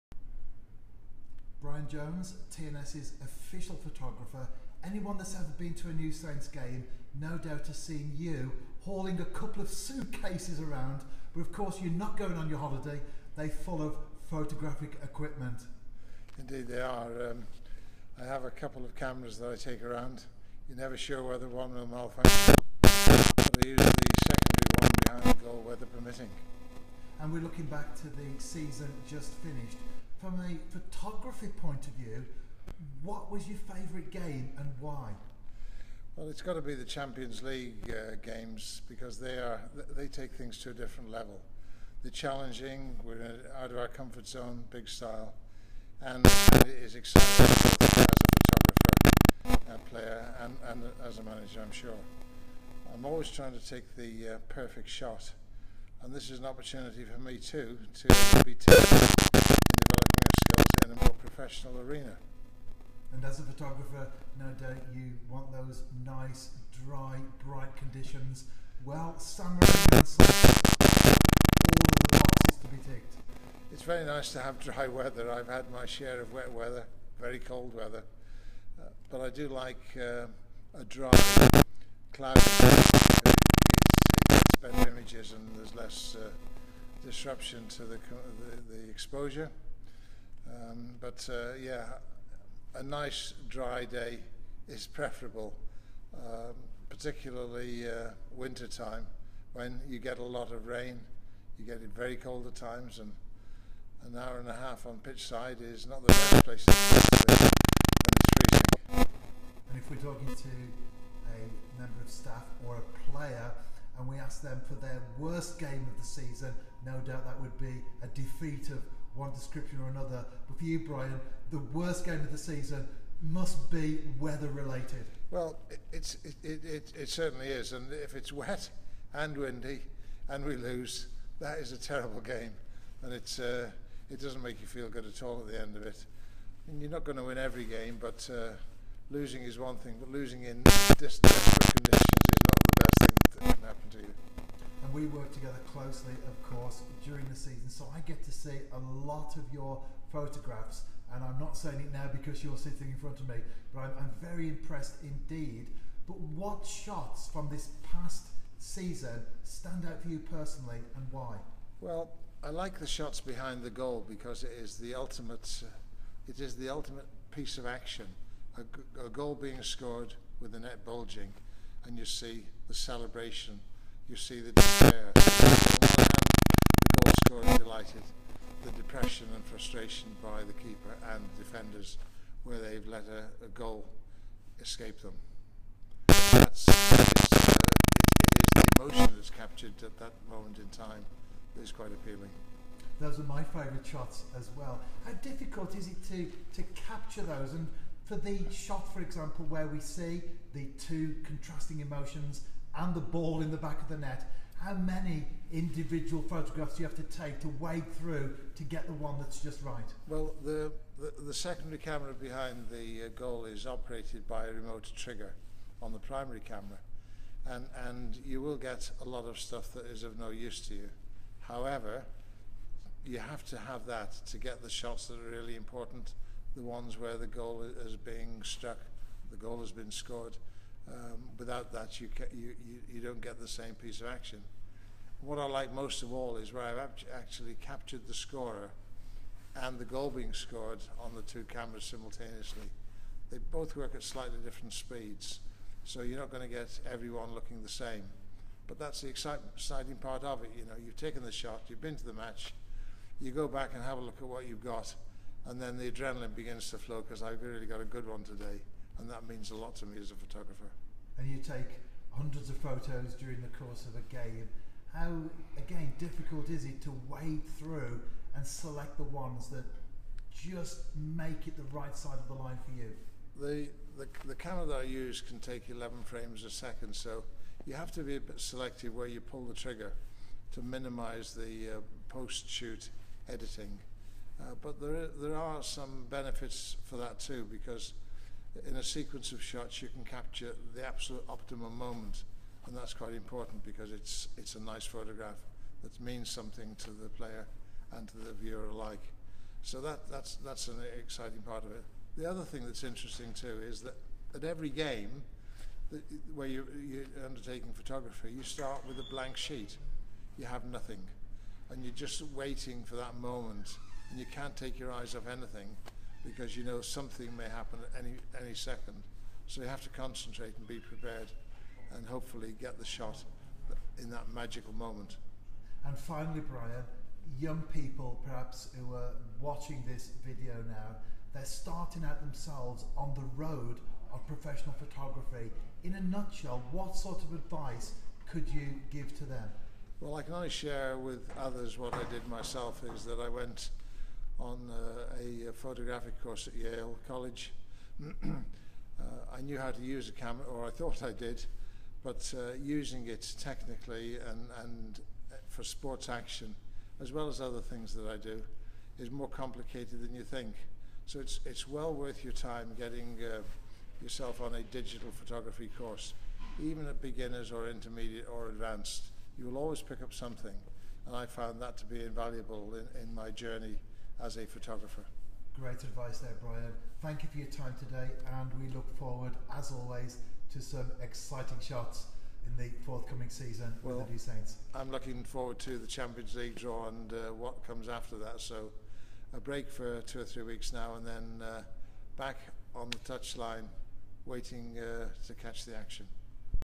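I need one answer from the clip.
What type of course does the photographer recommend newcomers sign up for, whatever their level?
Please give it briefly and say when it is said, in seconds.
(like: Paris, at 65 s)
digital photography course, at 364 s.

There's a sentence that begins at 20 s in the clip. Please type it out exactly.
You're never sure whether one will malfunction.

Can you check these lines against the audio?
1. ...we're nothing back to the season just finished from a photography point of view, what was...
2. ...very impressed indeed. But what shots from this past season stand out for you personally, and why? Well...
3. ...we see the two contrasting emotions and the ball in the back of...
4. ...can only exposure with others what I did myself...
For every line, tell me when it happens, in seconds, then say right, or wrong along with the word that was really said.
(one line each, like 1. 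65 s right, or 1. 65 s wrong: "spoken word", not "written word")
1. 27 s wrong: "looking", not "nothing"
2. 154 s right
3. 199 s right
4. 340 s wrong: "share", not "exposure".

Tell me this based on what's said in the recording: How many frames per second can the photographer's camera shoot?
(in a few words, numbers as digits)
11.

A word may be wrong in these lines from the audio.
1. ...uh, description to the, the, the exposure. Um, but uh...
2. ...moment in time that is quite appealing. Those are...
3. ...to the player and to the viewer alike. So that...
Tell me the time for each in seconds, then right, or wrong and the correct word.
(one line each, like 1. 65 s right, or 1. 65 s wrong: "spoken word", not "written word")
1. 86 s wrong: "disruption", not "description"
2. 190 s right
3. 296 s right.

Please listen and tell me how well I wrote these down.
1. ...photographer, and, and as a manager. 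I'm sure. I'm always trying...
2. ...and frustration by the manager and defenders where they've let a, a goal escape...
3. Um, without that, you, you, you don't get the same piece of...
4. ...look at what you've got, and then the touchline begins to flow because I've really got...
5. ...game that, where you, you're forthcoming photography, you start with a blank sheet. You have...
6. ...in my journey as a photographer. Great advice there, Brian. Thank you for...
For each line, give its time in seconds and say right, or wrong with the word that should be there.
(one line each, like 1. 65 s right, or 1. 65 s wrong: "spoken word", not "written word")
1. 49 s wrong: "player", not "photographer"
2. 179 s wrong: "keeper", not "manager"
3. 230 s right
4. 254 s wrong: "adrenaline", not "touchline"
5. 304 s wrong: "undertaking", not "forthcoming"
6. 373 s right.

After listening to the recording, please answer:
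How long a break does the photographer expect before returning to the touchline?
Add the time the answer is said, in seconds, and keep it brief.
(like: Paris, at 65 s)
two or three weeks, at 390 s.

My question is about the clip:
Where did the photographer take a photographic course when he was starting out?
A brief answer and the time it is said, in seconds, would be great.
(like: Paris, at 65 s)
Yale College, at 346 s.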